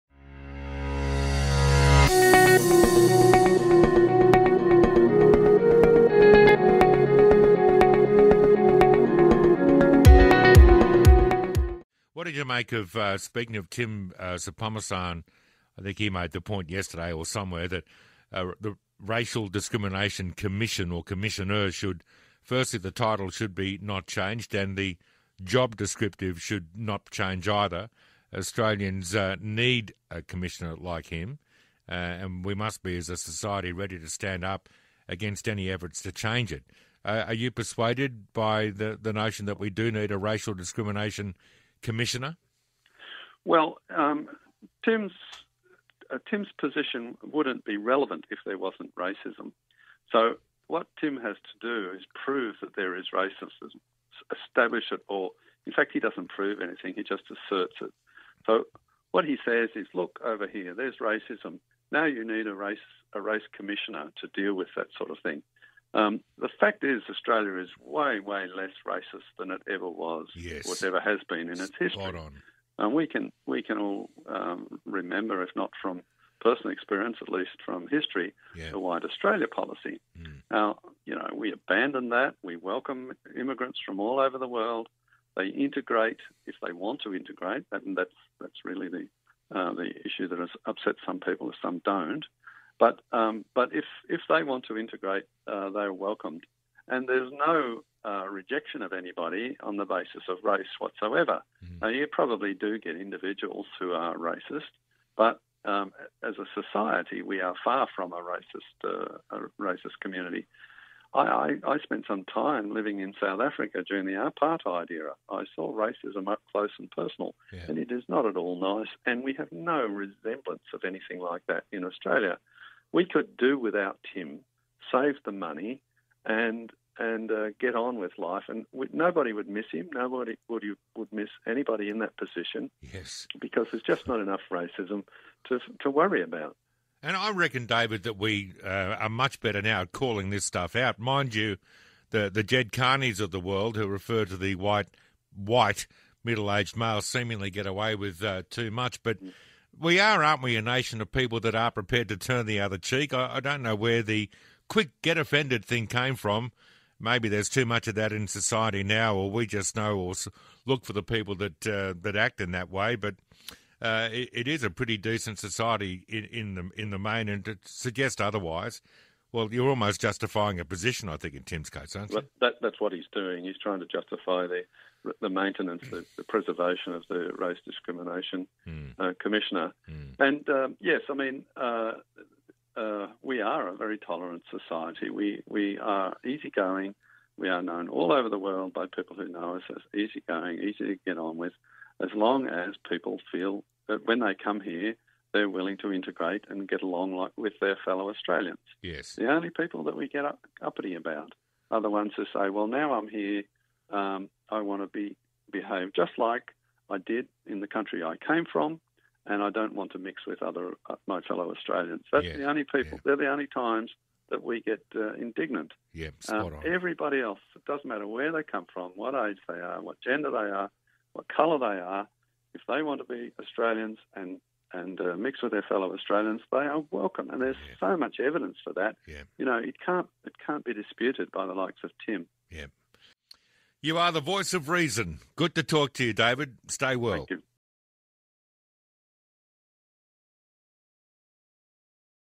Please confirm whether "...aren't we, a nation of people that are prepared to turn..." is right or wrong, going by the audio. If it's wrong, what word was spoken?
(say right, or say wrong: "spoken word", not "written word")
right.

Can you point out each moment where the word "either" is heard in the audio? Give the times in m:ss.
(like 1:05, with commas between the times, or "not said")
0:27.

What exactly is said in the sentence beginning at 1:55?
I saw racism up close and personal, yeah.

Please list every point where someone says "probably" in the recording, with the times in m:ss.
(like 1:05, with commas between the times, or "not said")
1:42.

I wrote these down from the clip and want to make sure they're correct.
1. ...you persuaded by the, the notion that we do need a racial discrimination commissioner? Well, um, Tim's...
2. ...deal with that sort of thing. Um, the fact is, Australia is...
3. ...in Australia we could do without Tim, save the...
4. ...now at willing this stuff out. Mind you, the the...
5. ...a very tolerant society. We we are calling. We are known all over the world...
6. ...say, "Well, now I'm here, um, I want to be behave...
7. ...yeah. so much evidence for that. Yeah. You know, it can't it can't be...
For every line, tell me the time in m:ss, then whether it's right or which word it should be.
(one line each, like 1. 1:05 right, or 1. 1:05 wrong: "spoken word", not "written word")
1. 0:37 right
2. 1:04 right
3. 2:01 right
4. 2:19 wrong: "calling", not "willing"
5. 3:03 wrong: "easygoing", not "calling"
6. 3:22 right
7. 3:47 right.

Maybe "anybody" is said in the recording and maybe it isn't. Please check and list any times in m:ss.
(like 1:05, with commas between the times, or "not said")
1:38, 2:11.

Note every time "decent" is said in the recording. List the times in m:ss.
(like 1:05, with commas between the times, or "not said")
2:44.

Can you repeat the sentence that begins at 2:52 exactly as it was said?
But that, that's what he's doing.